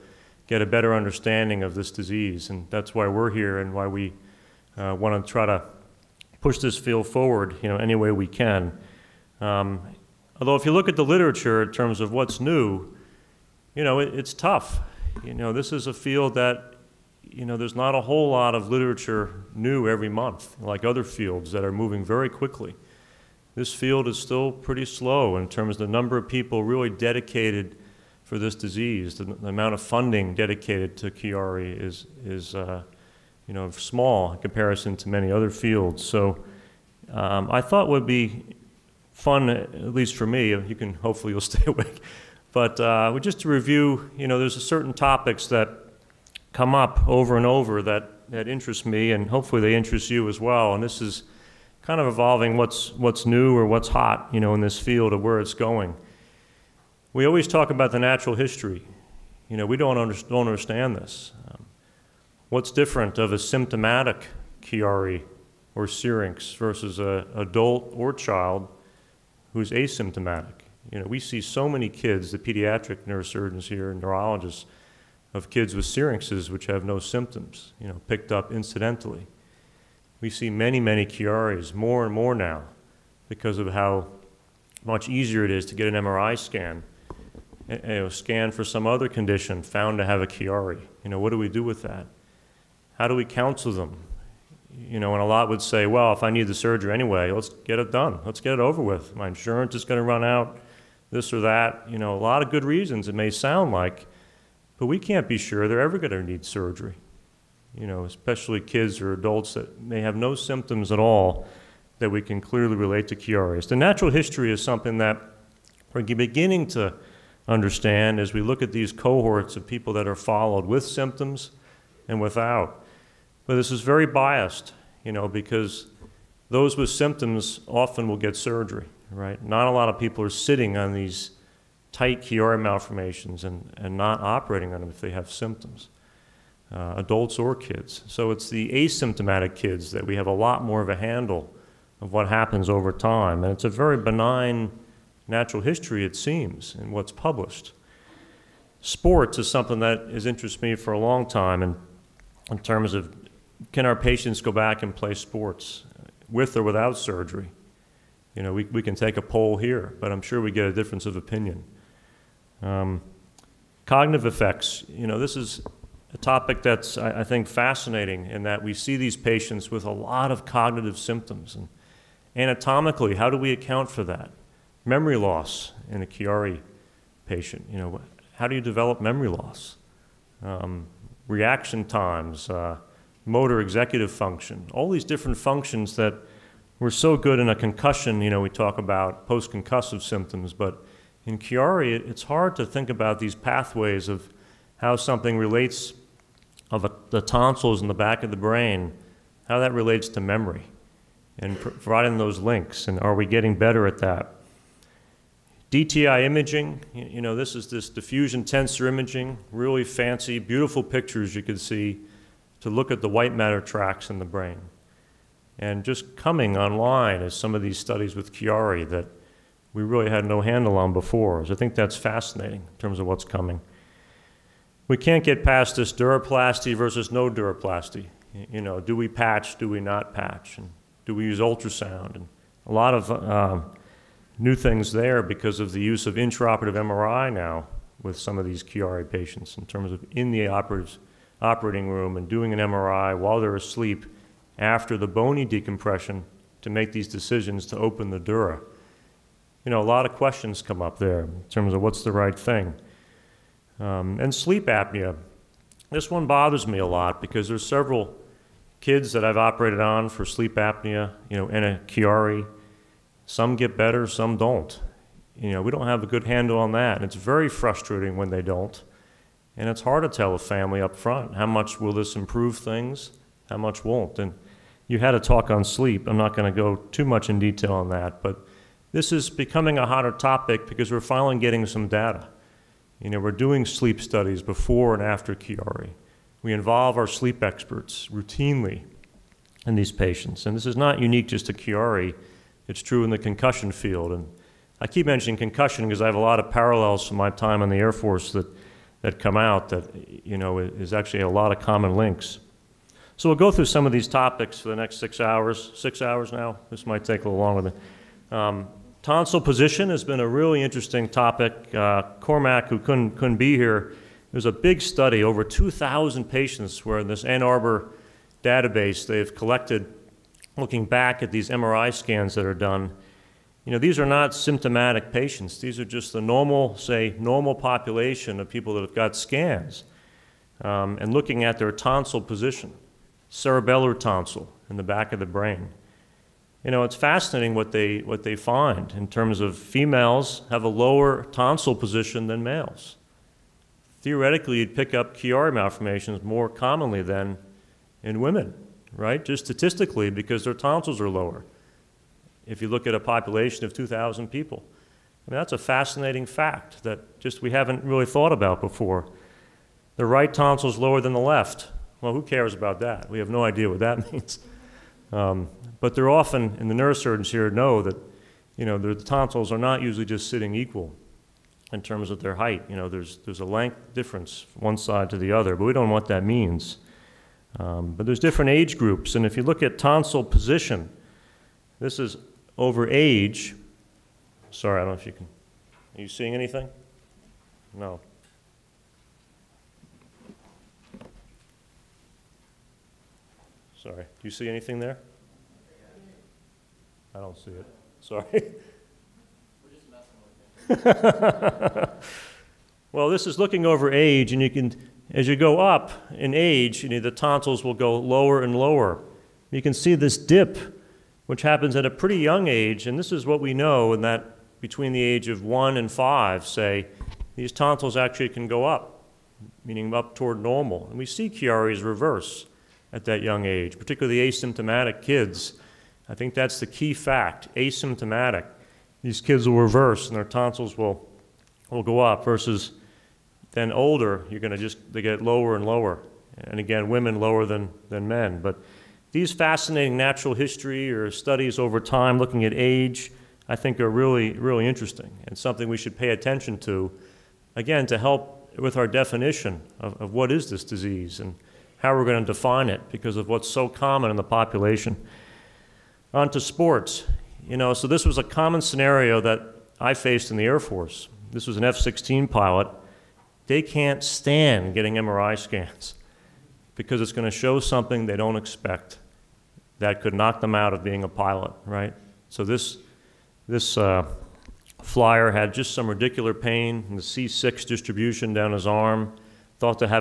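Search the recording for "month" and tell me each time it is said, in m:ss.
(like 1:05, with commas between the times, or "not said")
0:20.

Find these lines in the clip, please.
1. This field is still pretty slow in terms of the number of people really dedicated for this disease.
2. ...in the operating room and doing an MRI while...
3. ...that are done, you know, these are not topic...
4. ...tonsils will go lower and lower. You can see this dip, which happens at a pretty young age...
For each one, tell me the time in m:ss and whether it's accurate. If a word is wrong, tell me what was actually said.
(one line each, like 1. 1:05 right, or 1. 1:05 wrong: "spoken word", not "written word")
1. 0:23 right
2. 4:00 right
3. 5:22 wrong: "symptomatic", not "topic"
4. 6:47 right.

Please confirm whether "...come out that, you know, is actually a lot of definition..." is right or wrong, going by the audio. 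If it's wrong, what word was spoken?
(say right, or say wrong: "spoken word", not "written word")
wrong: "common", not "definition".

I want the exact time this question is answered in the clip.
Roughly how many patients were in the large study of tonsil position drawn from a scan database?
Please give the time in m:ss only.
5:15.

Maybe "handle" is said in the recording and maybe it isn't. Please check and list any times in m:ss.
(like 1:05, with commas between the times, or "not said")
2:20, 3:40, 4:26.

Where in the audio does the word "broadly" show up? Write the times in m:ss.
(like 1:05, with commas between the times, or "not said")
not said.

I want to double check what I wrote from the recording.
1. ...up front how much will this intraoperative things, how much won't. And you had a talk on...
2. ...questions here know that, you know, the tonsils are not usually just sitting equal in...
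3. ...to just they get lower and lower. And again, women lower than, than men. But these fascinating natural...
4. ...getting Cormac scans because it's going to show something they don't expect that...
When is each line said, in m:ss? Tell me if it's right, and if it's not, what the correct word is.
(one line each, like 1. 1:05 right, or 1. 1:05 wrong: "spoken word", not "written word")
1. 4:30 wrong: "improve", not "intraoperative"
2. 6:06 wrong: "neurosurgeons", not "questions"
3. 7:14 right
4. 7:44 wrong: "MRI", not "Cormac".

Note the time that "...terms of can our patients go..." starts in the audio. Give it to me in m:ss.
2:32.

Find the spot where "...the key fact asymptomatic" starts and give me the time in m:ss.
7:06.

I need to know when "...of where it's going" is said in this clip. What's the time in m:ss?
0:55.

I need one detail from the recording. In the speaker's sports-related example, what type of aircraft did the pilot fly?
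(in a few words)
F-16.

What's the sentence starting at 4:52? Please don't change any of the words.
It's true in the concussion field.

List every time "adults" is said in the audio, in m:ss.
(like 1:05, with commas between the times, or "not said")
1:07, 1:49, 2:16.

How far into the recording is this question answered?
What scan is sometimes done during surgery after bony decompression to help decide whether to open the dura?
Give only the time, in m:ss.
3:56.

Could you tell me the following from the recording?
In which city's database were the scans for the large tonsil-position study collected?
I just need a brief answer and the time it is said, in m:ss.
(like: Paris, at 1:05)
Ann Arbor, at 5:17.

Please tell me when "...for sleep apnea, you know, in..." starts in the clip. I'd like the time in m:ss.
4:20.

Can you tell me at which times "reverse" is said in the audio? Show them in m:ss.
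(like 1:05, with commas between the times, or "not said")
7:01, 7:09.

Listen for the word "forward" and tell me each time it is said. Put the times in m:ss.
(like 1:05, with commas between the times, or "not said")
0:07.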